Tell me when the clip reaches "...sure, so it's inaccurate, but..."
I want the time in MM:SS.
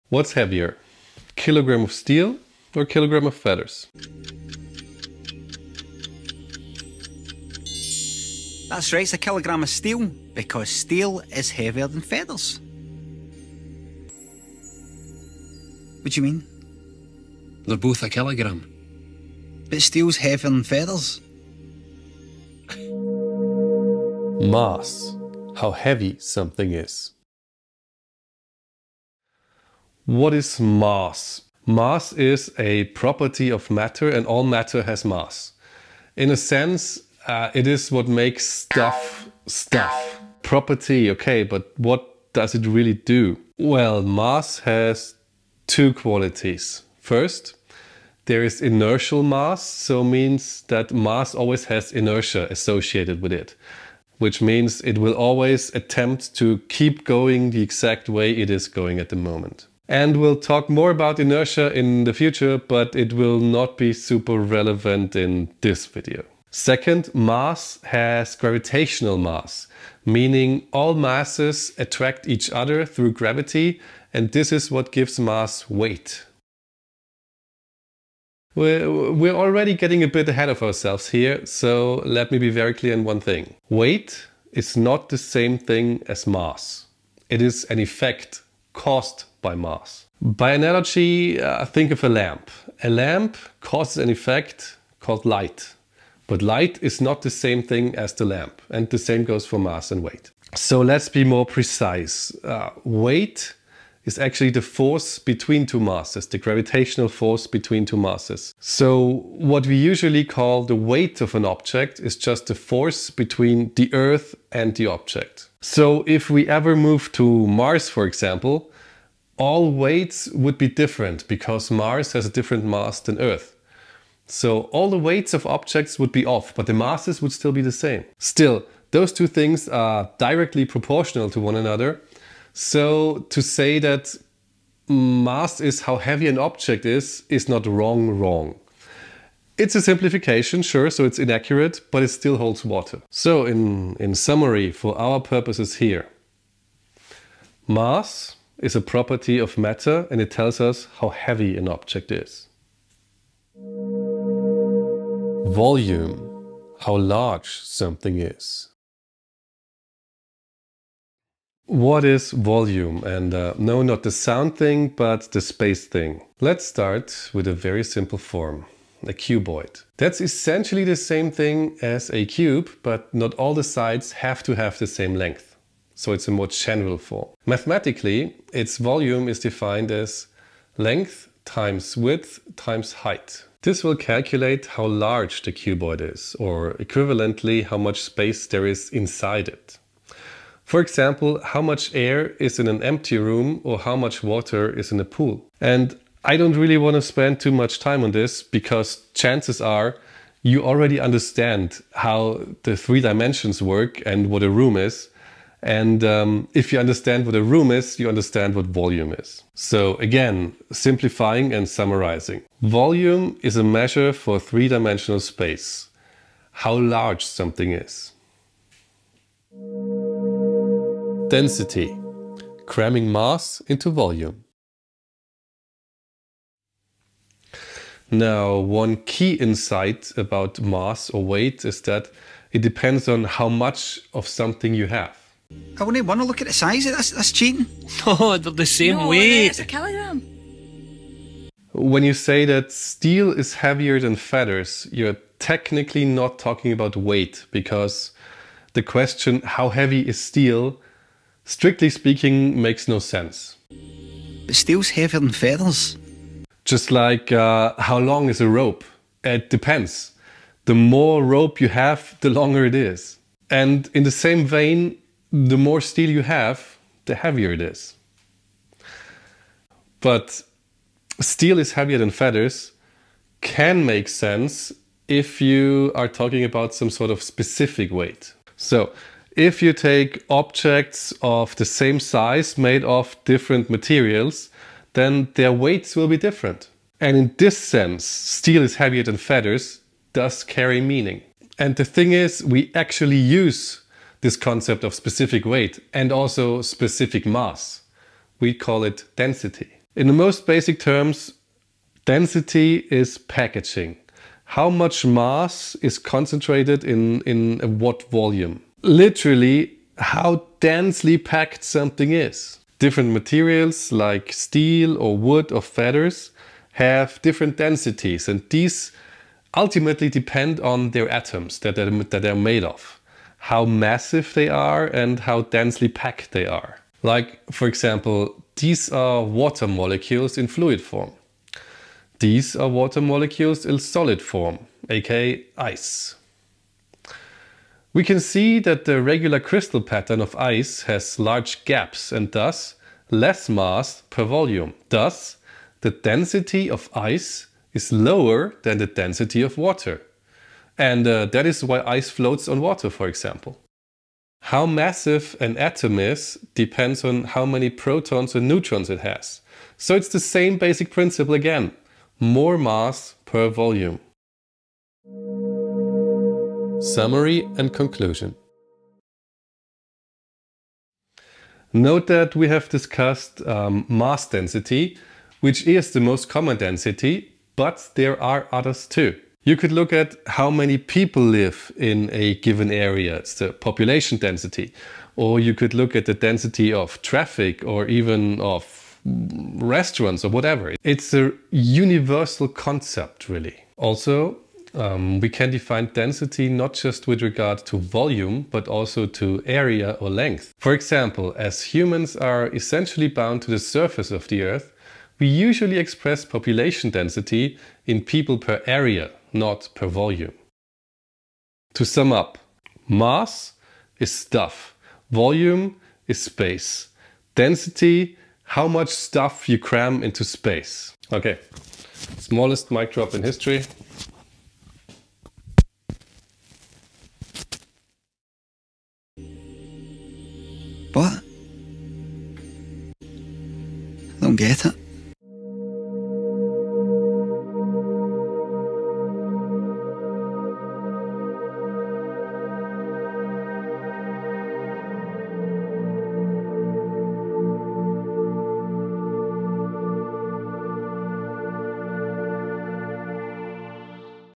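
02:20.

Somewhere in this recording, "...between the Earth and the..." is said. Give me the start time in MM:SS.
01:53.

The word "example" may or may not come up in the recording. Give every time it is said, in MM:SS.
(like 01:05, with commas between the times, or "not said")
01:58, 03:10, 05:27, 05:53, 06:40.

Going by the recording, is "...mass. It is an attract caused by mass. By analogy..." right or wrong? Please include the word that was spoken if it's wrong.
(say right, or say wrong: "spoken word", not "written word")
wrong: "effect", not "attract".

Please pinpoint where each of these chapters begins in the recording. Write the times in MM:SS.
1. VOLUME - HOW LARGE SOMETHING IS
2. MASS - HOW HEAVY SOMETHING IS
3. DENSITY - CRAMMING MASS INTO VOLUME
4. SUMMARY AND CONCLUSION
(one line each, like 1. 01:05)
1. 02:32
2. 00:22
3. 03:38
4. 06:04.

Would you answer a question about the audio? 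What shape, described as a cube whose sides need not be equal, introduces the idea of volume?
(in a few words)
a cuboid.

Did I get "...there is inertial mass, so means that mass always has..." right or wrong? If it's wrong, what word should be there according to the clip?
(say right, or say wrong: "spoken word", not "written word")
right.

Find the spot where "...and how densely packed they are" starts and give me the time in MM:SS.
05:24.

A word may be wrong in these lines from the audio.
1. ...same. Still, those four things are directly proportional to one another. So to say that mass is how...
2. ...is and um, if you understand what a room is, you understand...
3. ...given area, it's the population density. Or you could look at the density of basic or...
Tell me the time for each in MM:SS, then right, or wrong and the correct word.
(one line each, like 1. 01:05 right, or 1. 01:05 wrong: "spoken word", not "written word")
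1. 02:07 wrong: "two", not "four"
2. 03:24 right
3. 06:22 wrong: "traffic", not "basic".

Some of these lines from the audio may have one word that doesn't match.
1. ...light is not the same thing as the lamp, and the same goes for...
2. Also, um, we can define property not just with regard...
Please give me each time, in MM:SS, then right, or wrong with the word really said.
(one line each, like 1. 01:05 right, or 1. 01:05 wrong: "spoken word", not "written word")
1. 01:36 right
2. 06:33 wrong: "density", not "property".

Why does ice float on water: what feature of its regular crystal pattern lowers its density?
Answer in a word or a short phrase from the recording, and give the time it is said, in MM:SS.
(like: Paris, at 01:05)
large gaps, at 05:41.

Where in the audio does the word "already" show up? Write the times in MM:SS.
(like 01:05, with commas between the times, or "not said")
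01:19, 03:20.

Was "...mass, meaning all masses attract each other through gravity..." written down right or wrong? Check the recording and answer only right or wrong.
right.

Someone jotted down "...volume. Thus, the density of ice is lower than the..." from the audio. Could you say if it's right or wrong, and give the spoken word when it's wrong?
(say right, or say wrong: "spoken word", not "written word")
right.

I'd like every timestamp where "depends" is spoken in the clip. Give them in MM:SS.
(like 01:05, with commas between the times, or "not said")
03:52, 04:19, 05:20, 05:56.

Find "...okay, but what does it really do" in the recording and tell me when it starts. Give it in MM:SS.
00:41.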